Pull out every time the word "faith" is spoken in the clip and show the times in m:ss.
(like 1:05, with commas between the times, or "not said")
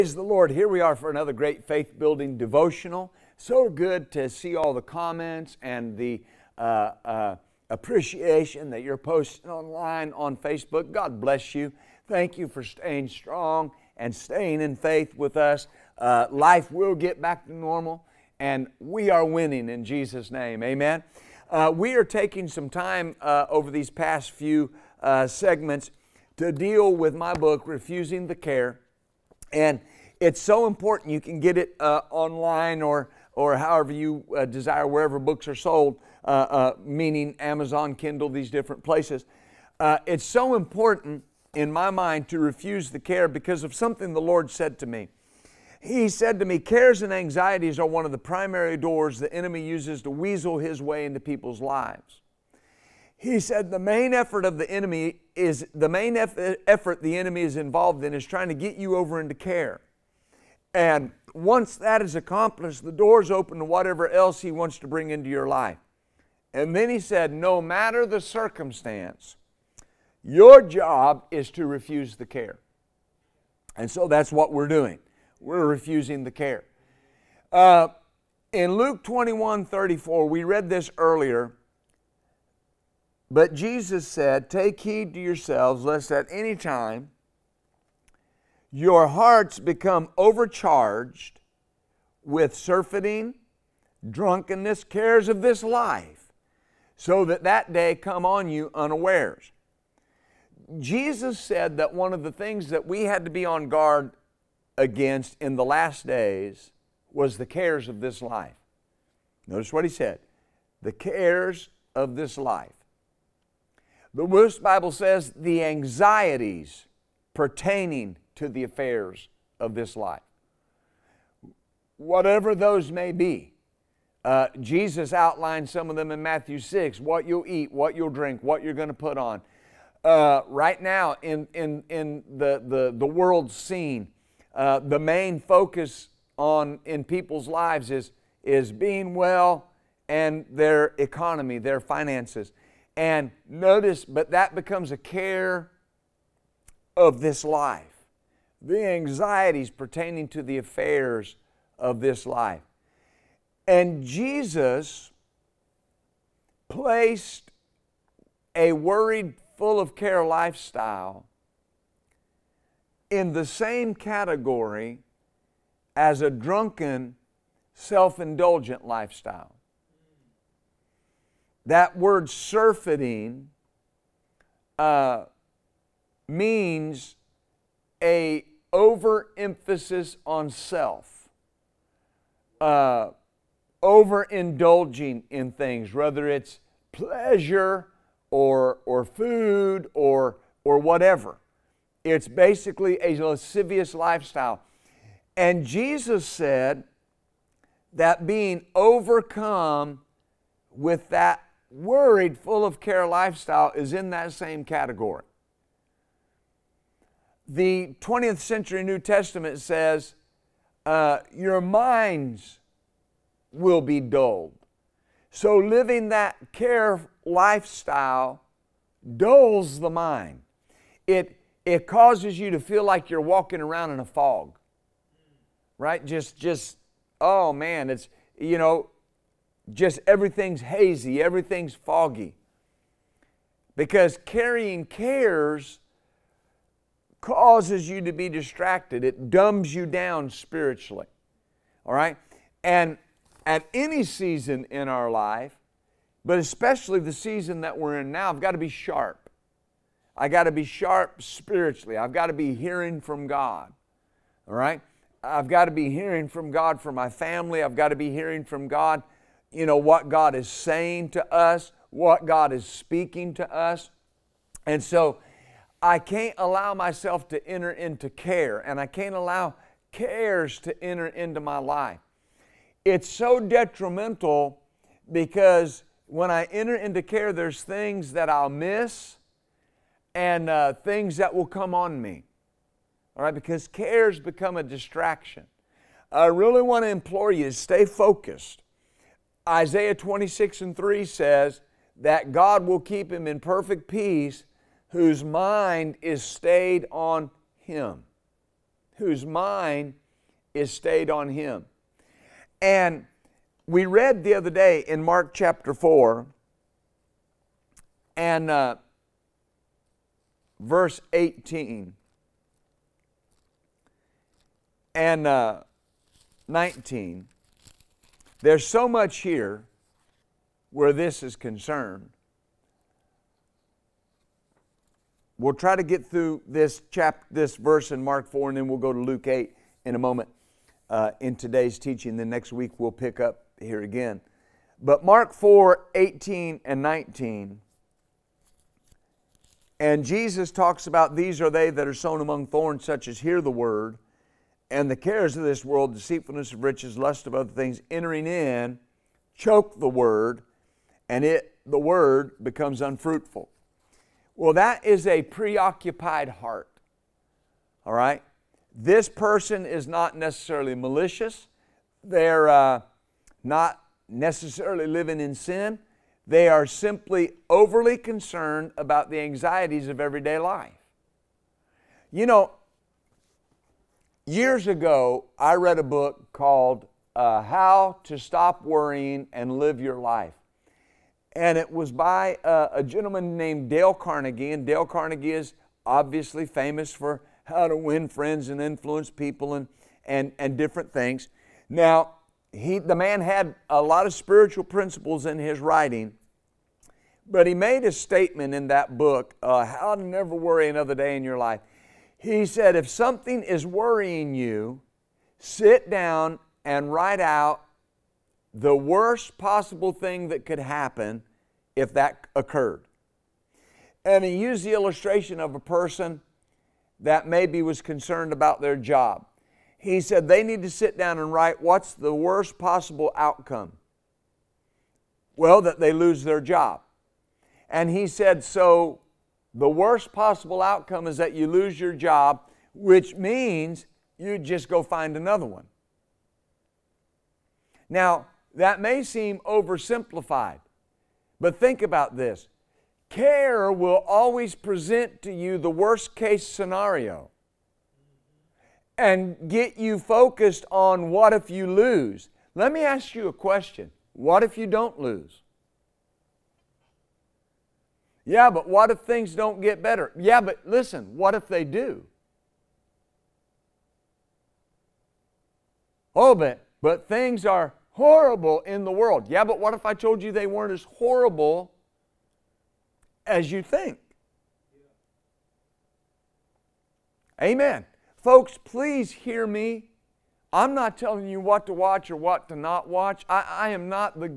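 0:01, 0:14.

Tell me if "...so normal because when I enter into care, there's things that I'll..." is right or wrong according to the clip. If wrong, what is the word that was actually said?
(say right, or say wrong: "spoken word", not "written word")
wrong: "detrimental", not "normal".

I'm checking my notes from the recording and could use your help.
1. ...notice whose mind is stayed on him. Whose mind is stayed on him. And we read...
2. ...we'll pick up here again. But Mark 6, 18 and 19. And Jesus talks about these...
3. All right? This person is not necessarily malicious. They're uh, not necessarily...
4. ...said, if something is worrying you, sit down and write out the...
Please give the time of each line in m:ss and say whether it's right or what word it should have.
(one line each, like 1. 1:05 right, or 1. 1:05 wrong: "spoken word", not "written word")
1. 4:53 wrong: "peace", not "notice"
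2. 5:32 wrong: "4", not "6"
3. 5:57 right
4. 6:42 right.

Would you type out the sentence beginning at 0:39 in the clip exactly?
Uh, it's so important in my mind to refuse the care because of something the Lord said to me.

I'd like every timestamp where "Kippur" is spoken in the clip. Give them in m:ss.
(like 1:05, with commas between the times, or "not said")
not said.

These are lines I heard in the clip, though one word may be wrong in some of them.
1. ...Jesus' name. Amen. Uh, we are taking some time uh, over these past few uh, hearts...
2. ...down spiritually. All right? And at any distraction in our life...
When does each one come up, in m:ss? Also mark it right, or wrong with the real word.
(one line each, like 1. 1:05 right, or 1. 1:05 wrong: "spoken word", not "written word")
1. 0:19 wrong: "segments", not "hearts"
2. 3:59 wrong: "season", not "distraction".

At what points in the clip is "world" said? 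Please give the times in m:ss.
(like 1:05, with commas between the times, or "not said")
2:13, 5:45, 7:48.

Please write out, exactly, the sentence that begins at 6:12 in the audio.
You know, Years ago, I read a book called uh, How to Stop Worrying and Live Your Life.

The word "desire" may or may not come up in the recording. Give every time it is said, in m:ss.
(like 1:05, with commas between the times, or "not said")
0:34.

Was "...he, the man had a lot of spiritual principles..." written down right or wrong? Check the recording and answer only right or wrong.
right.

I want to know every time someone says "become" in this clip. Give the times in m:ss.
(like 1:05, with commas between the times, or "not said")
1:29, 2:24, 4:44, 5:52.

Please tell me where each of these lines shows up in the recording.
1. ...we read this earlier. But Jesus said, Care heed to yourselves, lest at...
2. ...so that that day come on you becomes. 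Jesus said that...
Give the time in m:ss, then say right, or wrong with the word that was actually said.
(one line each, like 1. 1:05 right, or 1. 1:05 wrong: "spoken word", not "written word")
1. 1:20 wrong: "Take", not "Care"
2. 1:36 wrong: "unawares", not "becomes".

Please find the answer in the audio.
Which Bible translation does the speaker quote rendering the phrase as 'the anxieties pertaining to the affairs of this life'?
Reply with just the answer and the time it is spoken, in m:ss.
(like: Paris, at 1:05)
Wuest, at 1:54.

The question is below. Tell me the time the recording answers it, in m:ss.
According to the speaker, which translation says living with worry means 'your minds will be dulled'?
3:28.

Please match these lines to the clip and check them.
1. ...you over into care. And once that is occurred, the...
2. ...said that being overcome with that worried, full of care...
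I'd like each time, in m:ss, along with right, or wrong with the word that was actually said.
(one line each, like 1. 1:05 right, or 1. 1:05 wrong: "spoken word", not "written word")
1. 0:58 wrong: "accomplished", not "occurred"
2. 3:16 right.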